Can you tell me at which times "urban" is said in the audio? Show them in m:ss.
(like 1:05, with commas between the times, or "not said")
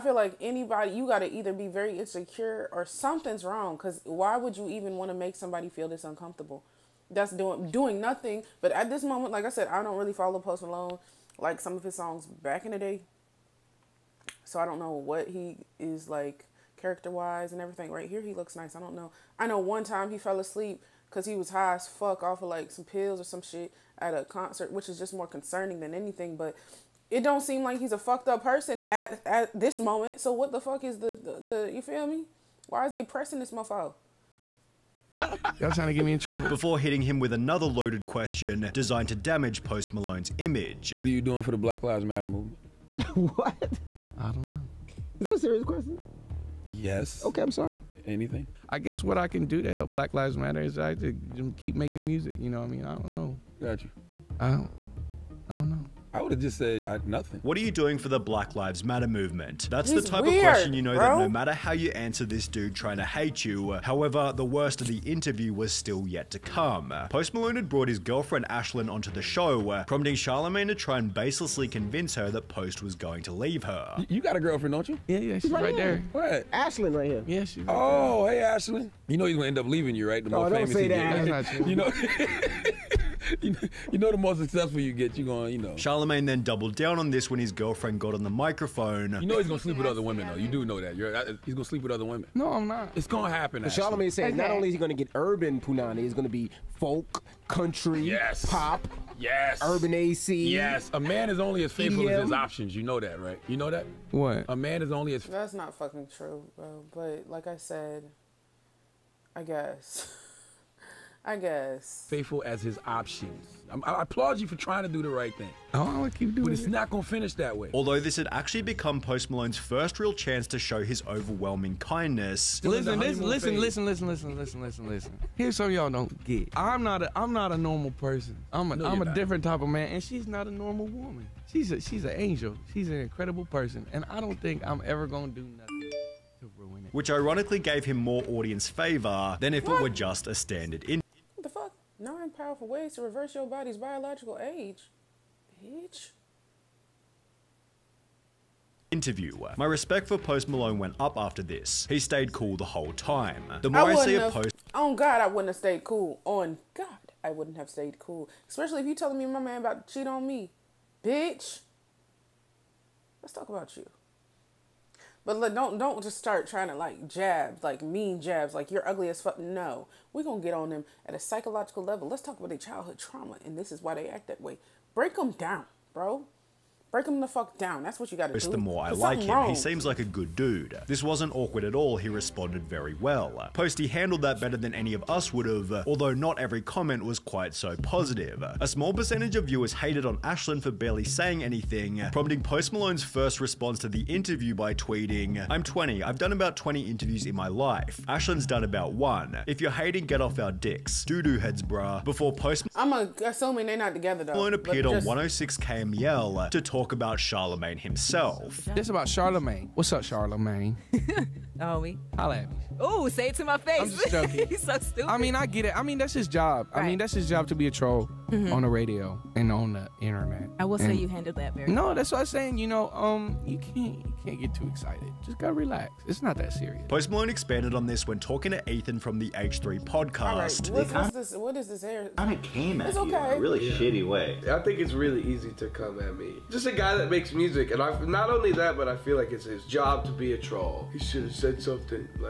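1:35, 1:39.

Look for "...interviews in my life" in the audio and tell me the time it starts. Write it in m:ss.
3:16.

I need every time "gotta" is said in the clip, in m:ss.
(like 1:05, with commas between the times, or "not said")
2:58, 3:45.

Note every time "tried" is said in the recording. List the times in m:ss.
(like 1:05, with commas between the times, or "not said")
not said.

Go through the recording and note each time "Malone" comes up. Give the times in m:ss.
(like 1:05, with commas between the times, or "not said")
0:10, 0:39, 1:07, 1:59, 2:30, 3:12, 3:24, 3:47.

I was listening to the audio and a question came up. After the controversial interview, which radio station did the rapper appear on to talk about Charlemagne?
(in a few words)
106 KMEL.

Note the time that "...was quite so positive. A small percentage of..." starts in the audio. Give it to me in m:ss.
3:07.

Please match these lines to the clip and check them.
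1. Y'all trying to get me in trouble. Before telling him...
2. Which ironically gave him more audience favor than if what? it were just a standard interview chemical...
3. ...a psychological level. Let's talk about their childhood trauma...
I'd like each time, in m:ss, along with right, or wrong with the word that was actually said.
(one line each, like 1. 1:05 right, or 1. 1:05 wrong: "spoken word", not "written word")
1. 0:35 wrong: "hitting", not "telling"
2. 2:16 right
3. 2:51 right.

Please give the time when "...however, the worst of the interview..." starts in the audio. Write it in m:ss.
1:03.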